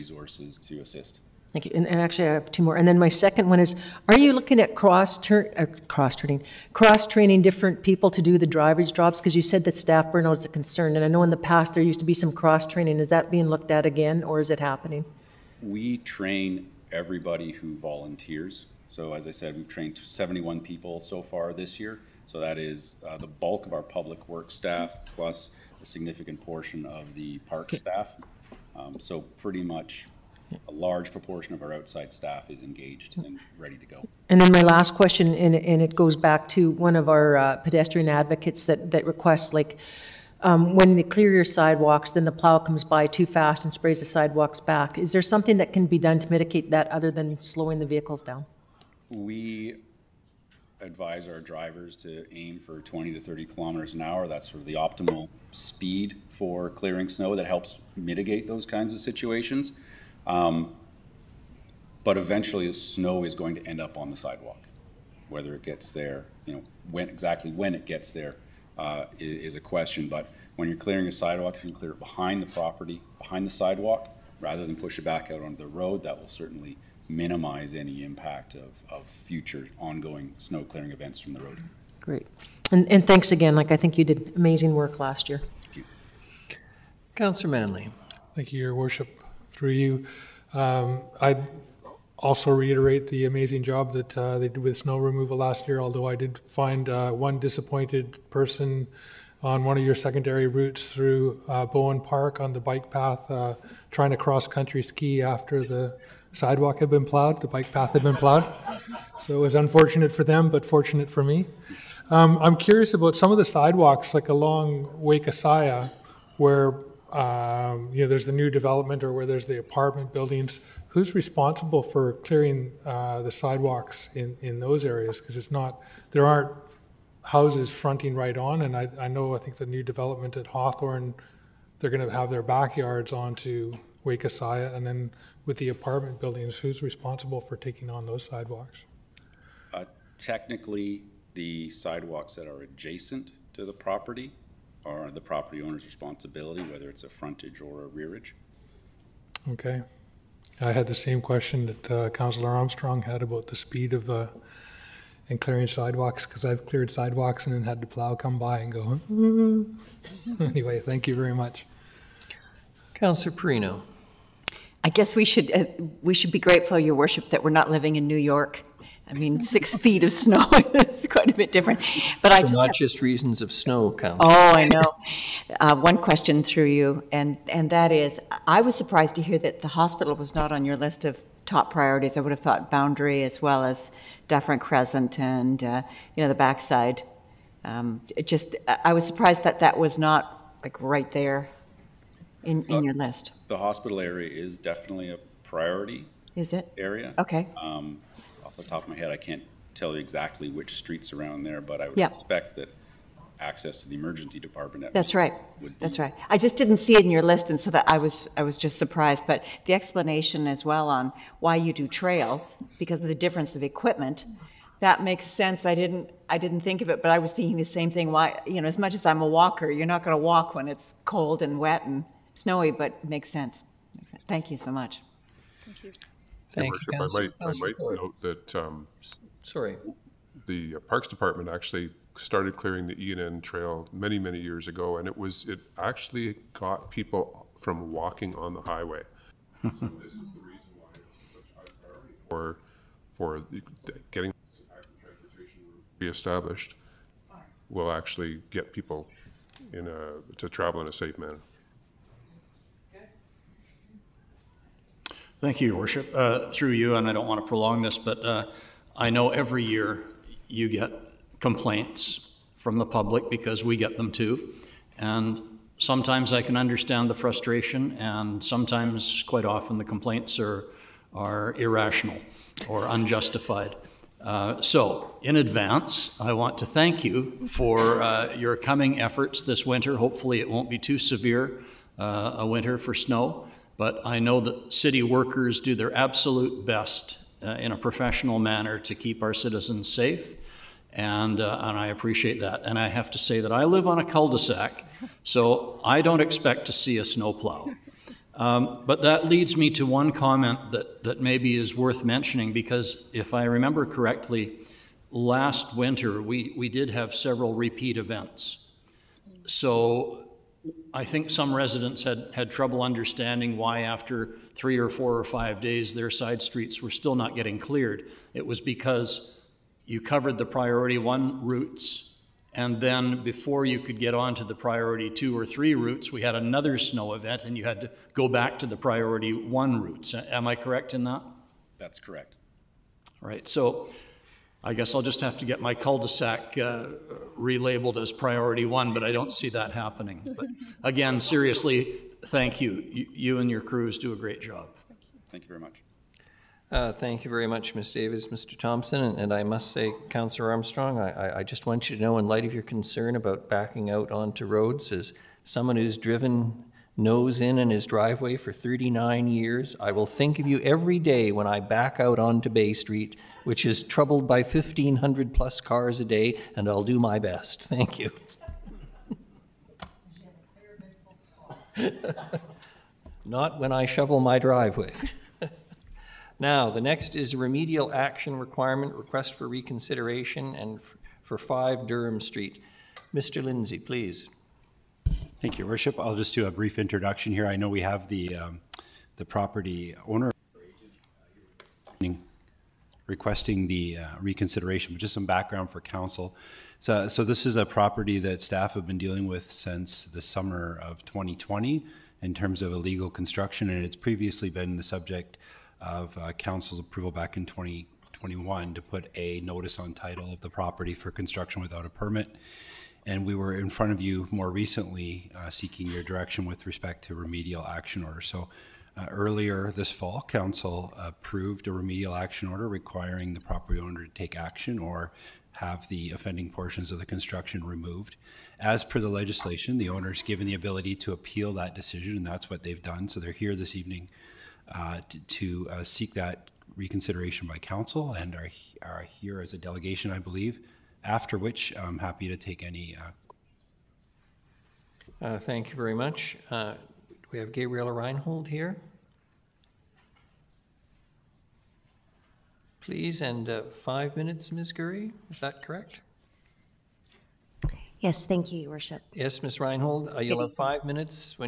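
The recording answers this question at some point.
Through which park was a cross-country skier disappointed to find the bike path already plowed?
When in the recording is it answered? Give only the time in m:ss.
1:41.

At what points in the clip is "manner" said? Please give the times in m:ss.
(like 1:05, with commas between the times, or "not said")
4:11, 4:48.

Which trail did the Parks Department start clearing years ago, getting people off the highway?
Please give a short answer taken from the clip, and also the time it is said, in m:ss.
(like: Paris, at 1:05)
E and N Trail, at 3:53.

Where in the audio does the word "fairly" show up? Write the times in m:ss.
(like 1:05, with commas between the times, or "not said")
not said.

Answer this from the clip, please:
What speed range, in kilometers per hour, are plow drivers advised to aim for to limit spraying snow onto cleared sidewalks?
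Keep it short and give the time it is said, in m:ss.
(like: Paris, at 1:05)
20 to 30, at 0:52.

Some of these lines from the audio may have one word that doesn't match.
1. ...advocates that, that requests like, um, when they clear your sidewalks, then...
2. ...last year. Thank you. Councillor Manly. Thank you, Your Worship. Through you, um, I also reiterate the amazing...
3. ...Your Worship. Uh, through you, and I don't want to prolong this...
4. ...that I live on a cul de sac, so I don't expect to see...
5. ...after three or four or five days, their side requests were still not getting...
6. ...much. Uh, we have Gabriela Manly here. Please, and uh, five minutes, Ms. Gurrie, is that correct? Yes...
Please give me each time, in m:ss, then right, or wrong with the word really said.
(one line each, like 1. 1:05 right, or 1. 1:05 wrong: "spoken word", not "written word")
1. 0:38 right
2. 1:24 right
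3. 4:15 right
4. 4:53 right
5. 5:13 wrong: "streets", not "requests"
6. 7:25 wrong: "Reinhold", not "Manly".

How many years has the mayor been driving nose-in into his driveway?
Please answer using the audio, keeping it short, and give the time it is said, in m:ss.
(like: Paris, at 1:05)
39, at 5:58.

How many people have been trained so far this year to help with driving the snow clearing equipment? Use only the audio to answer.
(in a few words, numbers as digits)
71.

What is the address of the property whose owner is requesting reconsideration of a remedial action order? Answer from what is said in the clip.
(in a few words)
5 Durham Street.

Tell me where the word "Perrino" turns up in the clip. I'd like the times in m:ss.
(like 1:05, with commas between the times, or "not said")
2:43.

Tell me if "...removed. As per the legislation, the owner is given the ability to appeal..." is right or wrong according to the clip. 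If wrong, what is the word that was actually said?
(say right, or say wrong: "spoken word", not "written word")
right.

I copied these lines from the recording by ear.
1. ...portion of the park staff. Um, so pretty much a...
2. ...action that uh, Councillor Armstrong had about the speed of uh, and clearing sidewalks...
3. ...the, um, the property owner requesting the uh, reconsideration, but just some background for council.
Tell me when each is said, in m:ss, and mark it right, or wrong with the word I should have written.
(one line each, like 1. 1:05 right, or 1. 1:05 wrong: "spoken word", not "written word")
1. 0:26 right
2. 2:31 wrong: "question", not "action"
3. 6:28 right.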